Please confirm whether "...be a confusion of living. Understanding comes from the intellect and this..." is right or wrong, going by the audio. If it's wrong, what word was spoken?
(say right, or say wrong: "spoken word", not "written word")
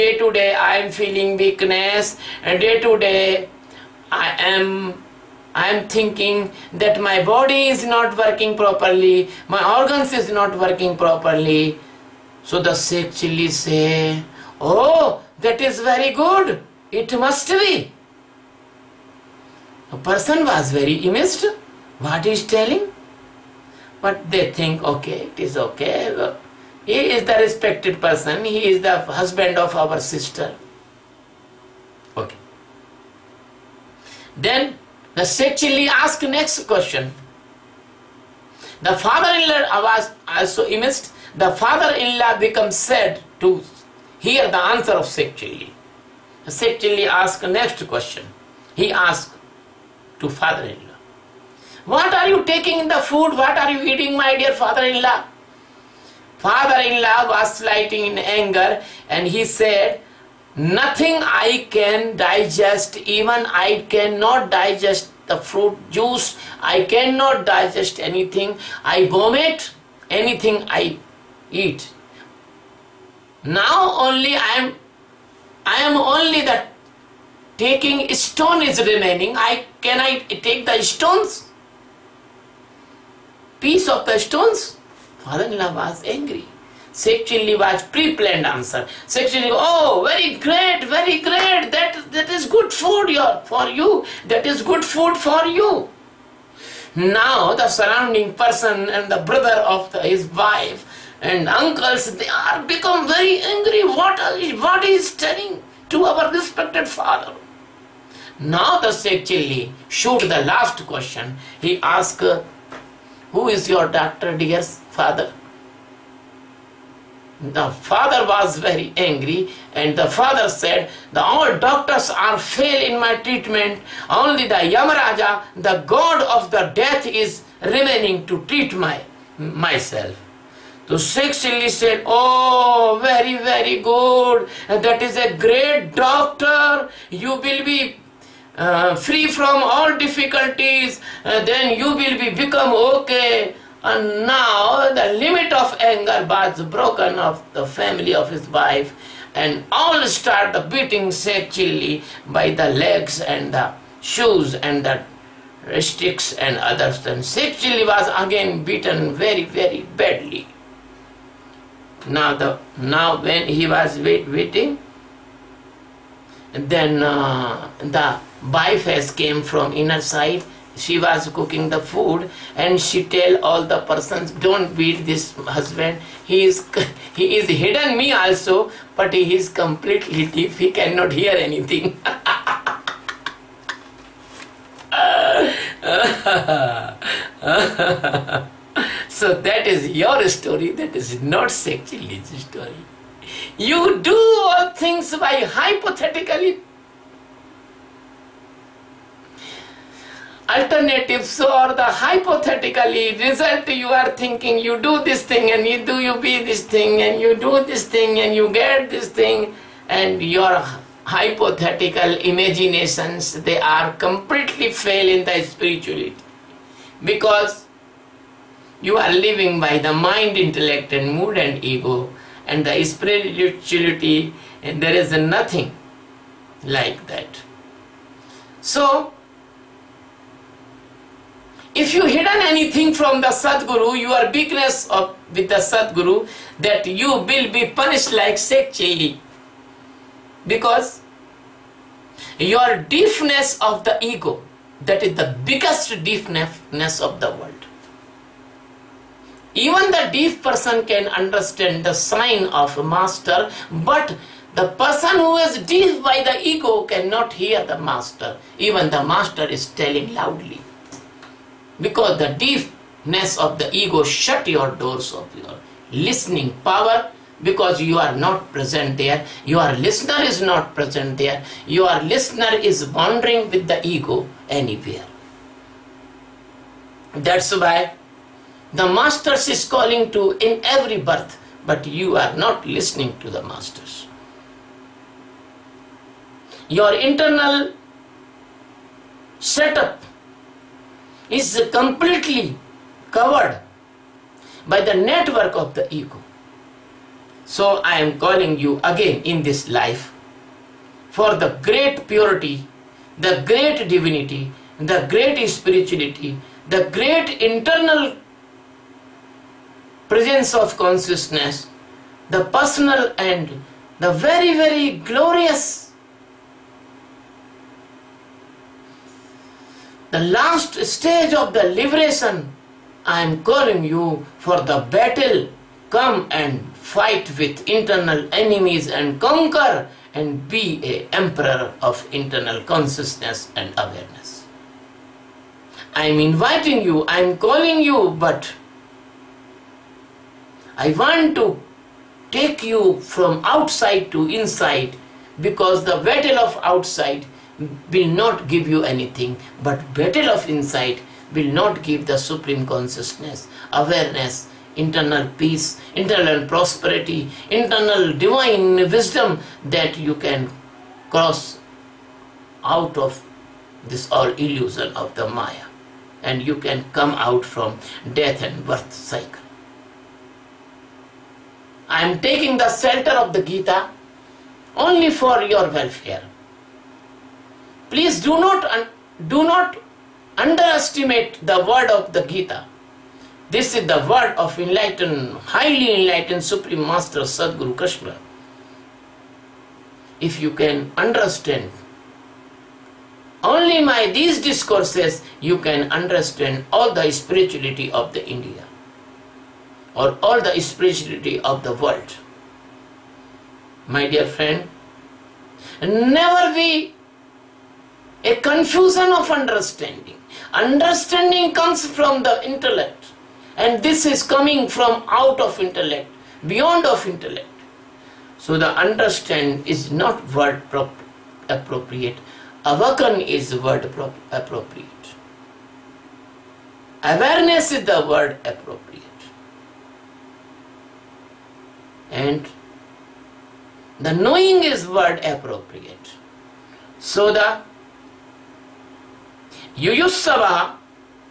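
wrong: "understanding", not "living".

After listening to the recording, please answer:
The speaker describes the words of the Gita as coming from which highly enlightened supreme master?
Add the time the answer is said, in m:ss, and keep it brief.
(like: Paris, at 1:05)
Sadguru Krishna, at 6:27.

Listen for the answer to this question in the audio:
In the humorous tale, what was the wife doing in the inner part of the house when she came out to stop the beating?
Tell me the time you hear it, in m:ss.
2:51.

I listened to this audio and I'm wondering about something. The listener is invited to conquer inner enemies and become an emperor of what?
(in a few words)
internal consciousness and awareness.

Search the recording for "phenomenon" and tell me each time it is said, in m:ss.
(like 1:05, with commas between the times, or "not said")
not said.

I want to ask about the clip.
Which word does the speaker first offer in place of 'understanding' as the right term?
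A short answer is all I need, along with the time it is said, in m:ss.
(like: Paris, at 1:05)
Awaken, at 7:02.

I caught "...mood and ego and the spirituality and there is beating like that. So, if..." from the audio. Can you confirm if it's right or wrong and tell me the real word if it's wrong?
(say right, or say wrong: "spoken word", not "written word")
wrong: "nothing", not "beating".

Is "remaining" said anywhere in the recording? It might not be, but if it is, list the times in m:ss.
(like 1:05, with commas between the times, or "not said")
1:18, 2:07.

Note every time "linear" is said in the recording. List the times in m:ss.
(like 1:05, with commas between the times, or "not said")
not said.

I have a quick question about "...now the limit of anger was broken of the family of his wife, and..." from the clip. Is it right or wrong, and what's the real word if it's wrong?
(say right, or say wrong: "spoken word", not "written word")
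right.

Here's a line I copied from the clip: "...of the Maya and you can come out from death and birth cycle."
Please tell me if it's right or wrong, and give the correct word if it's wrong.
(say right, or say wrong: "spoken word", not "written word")
right.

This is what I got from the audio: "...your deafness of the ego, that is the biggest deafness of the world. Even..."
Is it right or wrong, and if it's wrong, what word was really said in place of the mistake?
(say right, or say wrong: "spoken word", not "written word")
right.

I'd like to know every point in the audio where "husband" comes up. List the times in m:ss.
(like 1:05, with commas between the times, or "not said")
0:29, 2:55.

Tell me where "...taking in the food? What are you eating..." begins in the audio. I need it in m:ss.
0:52.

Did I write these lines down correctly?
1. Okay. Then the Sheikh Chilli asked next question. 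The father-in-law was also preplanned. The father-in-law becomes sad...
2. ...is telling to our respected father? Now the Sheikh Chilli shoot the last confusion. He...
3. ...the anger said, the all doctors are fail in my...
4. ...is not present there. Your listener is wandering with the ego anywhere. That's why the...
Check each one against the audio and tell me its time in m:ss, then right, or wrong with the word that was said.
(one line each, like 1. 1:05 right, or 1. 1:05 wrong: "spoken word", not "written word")
1. 0:32 wrong: "amazed", not "preplanned"
2. 1:44 wrong: "question", not "confusion"
3. 1:59 wrong: "father", not "anger"
4. 4:30 right.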